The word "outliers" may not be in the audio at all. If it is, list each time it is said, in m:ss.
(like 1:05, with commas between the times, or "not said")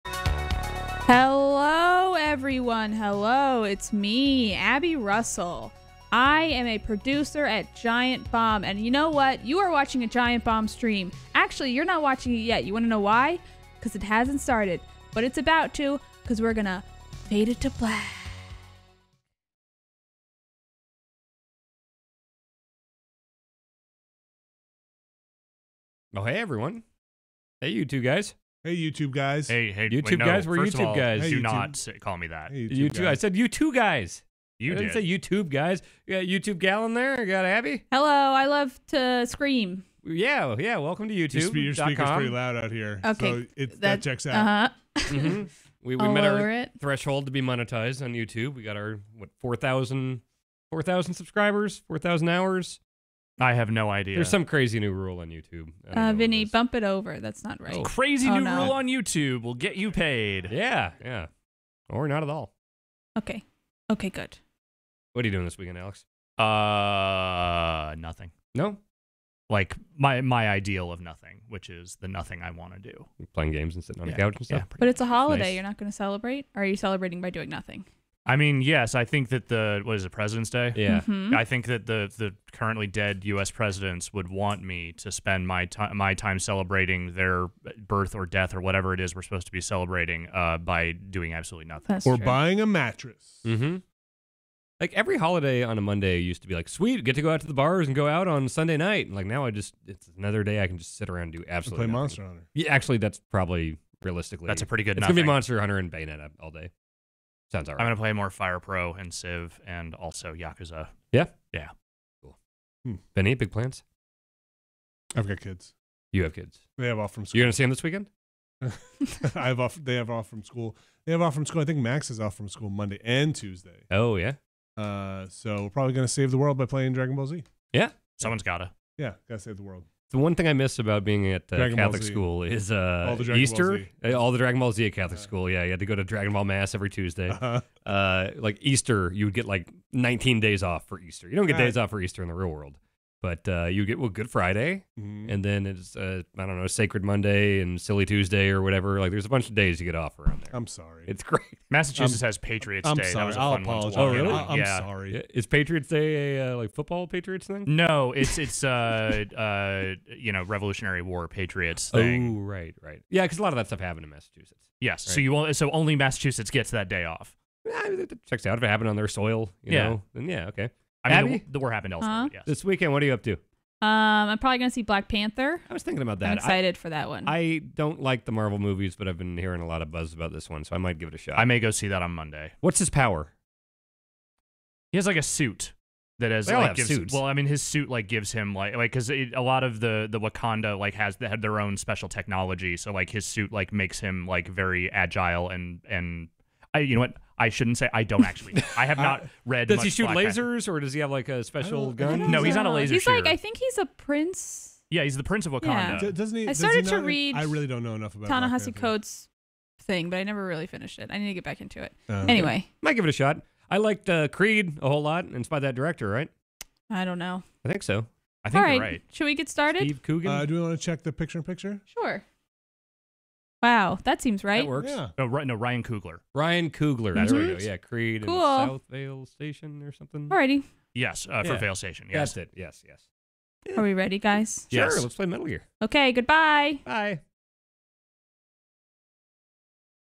not said.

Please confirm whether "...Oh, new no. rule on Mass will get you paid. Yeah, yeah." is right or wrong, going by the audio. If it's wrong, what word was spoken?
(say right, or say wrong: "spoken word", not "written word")
wrong: "YouTube", not "Mass".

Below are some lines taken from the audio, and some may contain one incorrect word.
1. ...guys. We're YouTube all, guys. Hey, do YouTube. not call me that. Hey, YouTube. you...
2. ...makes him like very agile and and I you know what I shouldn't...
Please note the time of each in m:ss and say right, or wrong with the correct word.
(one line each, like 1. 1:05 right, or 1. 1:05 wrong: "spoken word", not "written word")
1. 0:30 right
2. 3:13 right.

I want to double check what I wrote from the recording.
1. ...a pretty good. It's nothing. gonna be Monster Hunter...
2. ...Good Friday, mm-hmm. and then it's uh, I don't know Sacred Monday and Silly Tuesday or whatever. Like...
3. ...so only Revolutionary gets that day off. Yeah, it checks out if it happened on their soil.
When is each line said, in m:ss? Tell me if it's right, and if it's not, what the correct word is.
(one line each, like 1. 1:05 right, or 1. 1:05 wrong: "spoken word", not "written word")
1. 1:44 right
2. 2:24 right
3. 2:45 wrong: "Massachusetts", not "Revolutionary".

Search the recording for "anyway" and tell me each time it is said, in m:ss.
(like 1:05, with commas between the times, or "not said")
3:32.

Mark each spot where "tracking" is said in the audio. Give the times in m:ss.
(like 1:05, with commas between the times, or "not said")
not said.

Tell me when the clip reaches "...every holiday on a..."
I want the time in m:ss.
1:34.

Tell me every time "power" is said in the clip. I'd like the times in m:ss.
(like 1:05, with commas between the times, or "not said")
3:02.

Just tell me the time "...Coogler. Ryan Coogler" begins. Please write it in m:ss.
3:45.